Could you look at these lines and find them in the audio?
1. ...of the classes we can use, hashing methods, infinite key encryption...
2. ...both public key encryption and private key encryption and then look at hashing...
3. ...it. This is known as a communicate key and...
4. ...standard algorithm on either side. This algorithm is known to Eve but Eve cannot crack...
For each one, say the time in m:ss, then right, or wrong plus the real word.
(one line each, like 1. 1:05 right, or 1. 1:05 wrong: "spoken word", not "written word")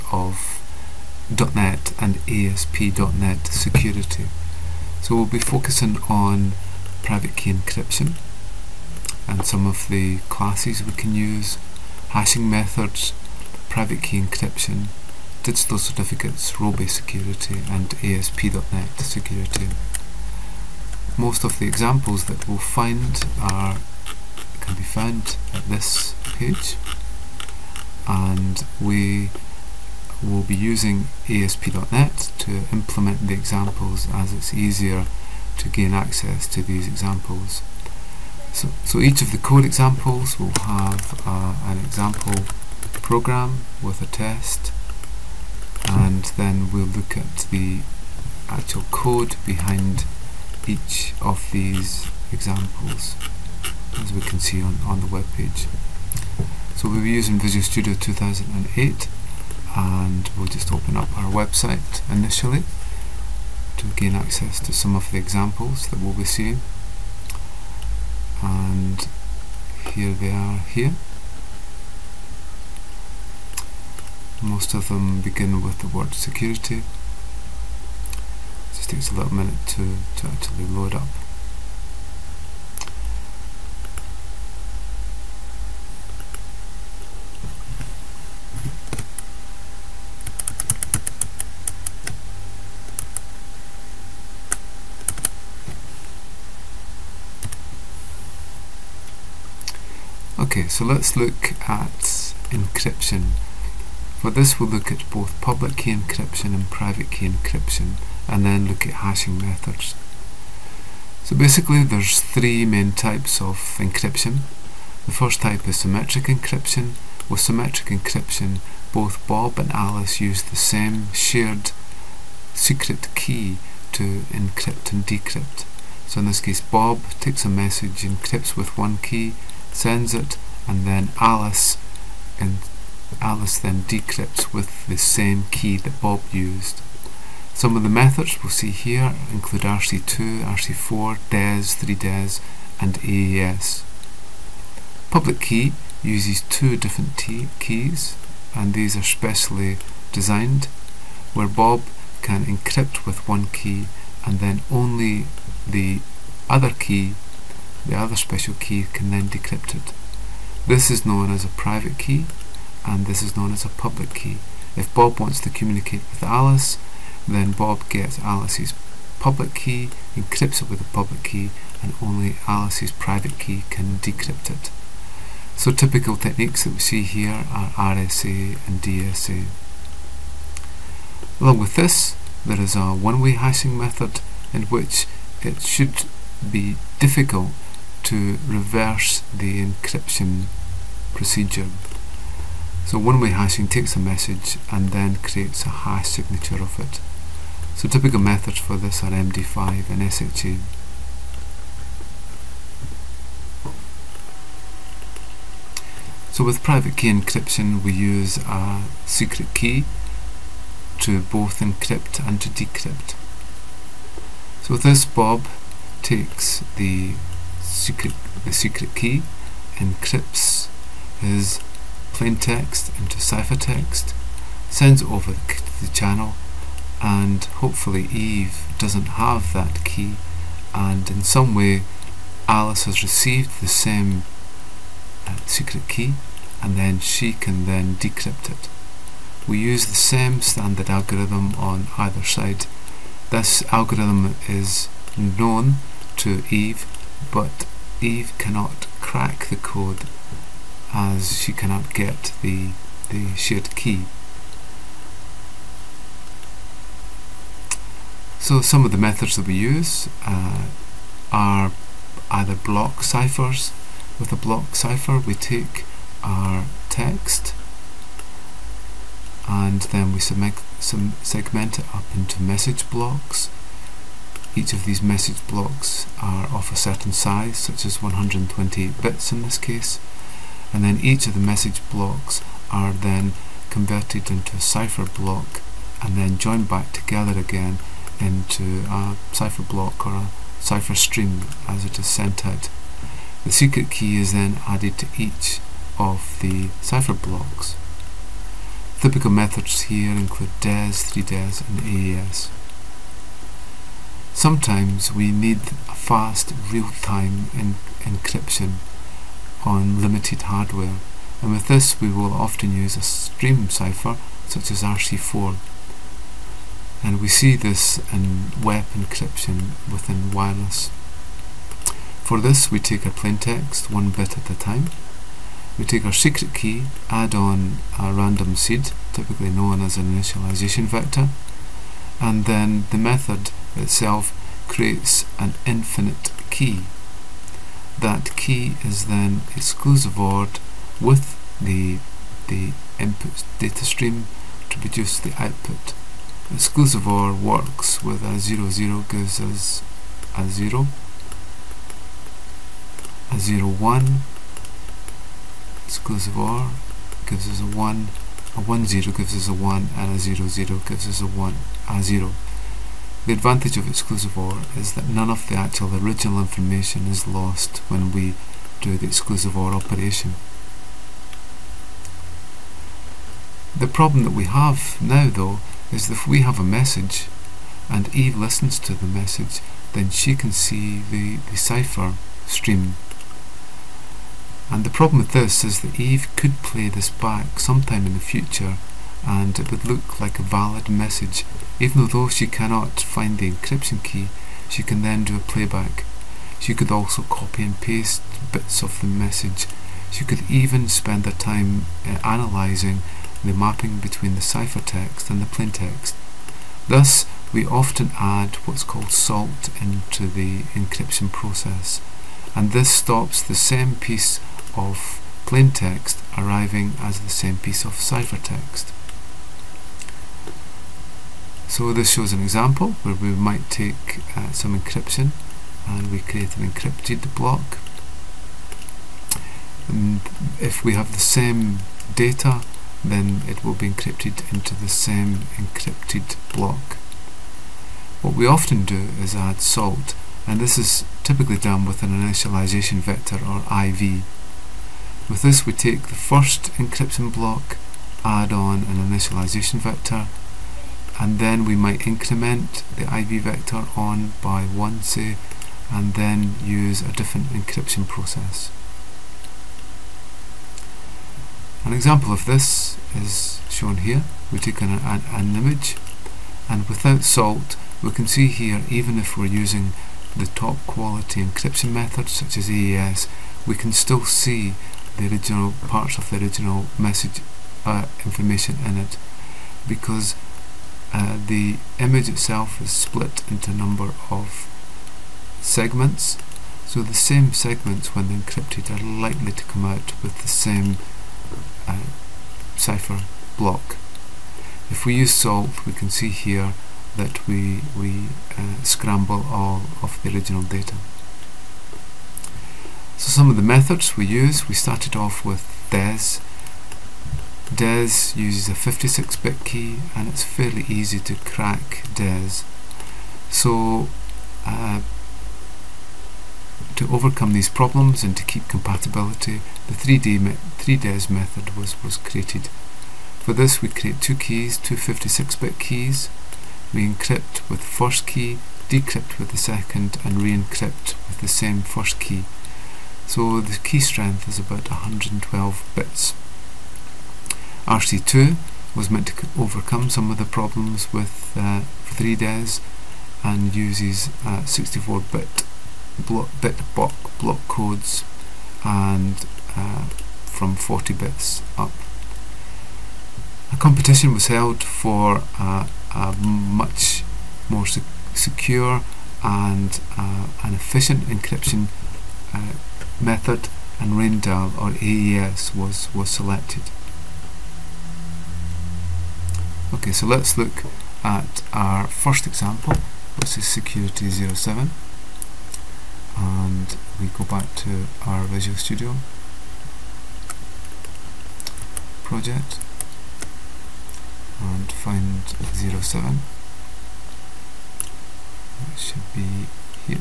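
1. 0:09 wrong: "private", not "infinite"
2. 1:45 right
3. 2:39 wrong: "private", not "communicate"
4. 4:00 right.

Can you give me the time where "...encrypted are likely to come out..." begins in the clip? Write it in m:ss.
8:08.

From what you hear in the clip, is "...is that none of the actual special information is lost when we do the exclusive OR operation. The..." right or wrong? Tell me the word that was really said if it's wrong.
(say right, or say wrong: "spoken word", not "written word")
wrong: "original", not "special".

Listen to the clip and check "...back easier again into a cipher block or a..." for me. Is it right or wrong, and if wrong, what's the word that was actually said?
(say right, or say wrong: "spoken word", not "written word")
wrong: "together", not "easier".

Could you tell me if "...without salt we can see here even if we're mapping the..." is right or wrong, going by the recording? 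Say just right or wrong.
wrong.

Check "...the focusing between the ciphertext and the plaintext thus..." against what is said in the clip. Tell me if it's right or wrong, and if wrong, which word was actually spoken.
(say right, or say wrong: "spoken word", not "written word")
wrong: "mapping", not "focusing".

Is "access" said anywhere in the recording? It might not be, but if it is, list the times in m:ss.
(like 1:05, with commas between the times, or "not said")
0:35, 1:04.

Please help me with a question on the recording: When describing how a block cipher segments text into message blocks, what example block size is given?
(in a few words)
128 bits.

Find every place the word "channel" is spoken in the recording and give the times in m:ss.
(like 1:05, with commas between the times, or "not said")
3:45.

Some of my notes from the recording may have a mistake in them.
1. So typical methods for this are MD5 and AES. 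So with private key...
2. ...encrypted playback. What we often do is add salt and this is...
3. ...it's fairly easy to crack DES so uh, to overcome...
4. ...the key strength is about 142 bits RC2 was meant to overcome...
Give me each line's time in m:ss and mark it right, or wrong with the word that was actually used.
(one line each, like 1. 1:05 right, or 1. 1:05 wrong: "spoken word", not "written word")
1. 3:17 wrong: "SHA", not "AES"
2. 7:15 wrong: "block", not "playback"
3. 8:30 right
4. 8:53 wrong: "112", not "142".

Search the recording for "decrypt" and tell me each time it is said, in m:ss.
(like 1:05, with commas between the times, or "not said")
2:05, 2:13, 2:39, 2:53, 3:32, 3:57, 8:48.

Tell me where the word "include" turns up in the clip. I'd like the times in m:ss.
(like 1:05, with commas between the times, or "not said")
2:19, 5:00.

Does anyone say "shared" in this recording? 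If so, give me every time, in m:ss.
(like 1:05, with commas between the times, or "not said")
2:01, 4:13.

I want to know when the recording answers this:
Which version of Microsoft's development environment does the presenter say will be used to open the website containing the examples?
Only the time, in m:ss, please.
0:57.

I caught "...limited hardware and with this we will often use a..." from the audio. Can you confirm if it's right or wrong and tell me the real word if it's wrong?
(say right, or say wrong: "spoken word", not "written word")
right.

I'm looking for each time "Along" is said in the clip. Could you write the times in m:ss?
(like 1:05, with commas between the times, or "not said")
3:01.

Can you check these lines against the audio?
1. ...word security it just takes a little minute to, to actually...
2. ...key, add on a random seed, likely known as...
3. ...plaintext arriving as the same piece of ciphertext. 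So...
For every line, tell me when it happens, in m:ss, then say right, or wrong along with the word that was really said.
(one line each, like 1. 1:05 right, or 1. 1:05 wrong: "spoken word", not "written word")
1. 1:15 right
2. 5:26 wrong: "typically", not "likely"
3. 6:55 right.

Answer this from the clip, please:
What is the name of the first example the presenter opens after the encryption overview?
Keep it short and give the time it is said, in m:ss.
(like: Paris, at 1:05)
Security 07, at 9:33.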